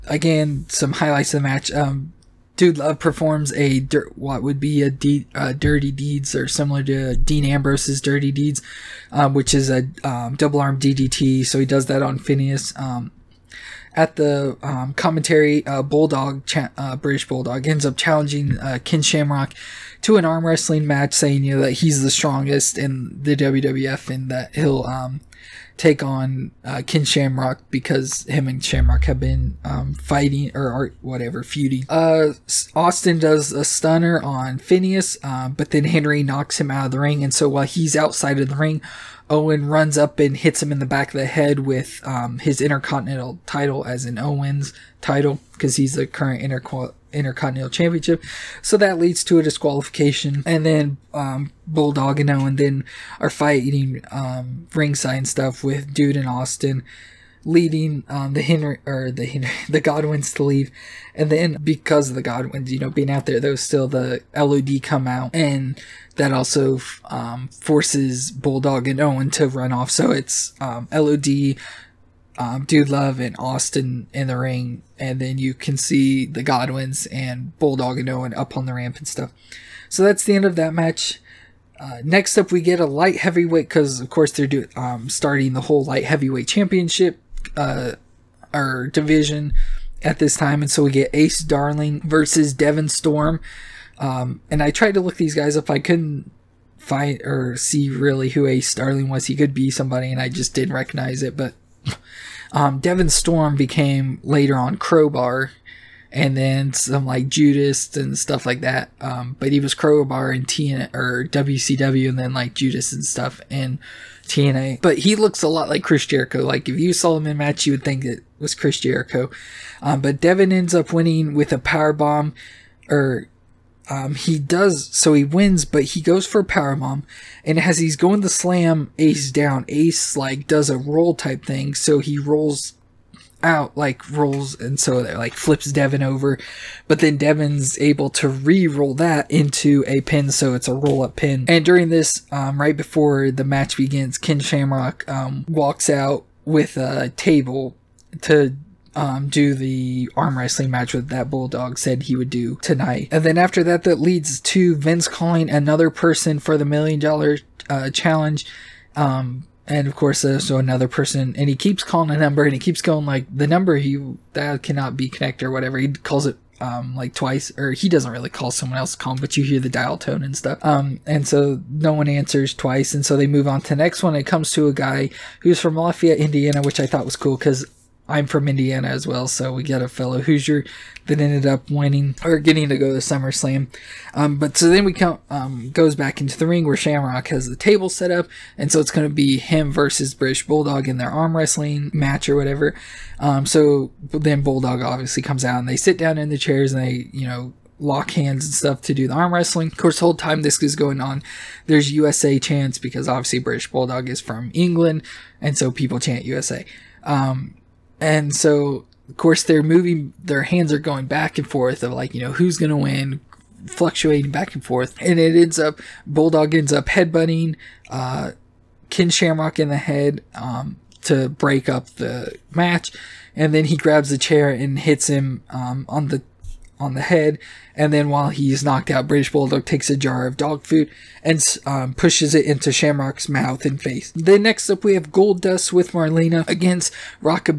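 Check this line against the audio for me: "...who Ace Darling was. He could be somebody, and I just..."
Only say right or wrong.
right.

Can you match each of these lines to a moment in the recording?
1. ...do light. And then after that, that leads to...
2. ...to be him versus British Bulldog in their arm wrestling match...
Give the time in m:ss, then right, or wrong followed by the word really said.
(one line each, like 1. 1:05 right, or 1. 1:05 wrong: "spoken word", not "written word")
1. 2:32 wrong: "tonight", not "light"
2. 3:09 right.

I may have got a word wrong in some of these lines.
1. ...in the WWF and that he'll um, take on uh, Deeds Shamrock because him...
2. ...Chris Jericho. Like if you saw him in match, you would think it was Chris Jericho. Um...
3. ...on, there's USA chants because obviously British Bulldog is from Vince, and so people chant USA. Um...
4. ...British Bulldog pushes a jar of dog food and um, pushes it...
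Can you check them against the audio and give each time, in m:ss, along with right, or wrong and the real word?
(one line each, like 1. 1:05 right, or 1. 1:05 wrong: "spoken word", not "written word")
1. 0:22 wrong: "Ken", not "Deeds"
2. 1:55 right
3. 3:20 wrong: "England", not "Vince"
4. 3:49 wrong: "takes", not "pushes".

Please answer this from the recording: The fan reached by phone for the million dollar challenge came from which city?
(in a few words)
Lafayette, Indiana.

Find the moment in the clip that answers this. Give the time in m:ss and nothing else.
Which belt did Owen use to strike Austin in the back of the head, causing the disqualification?
0:42.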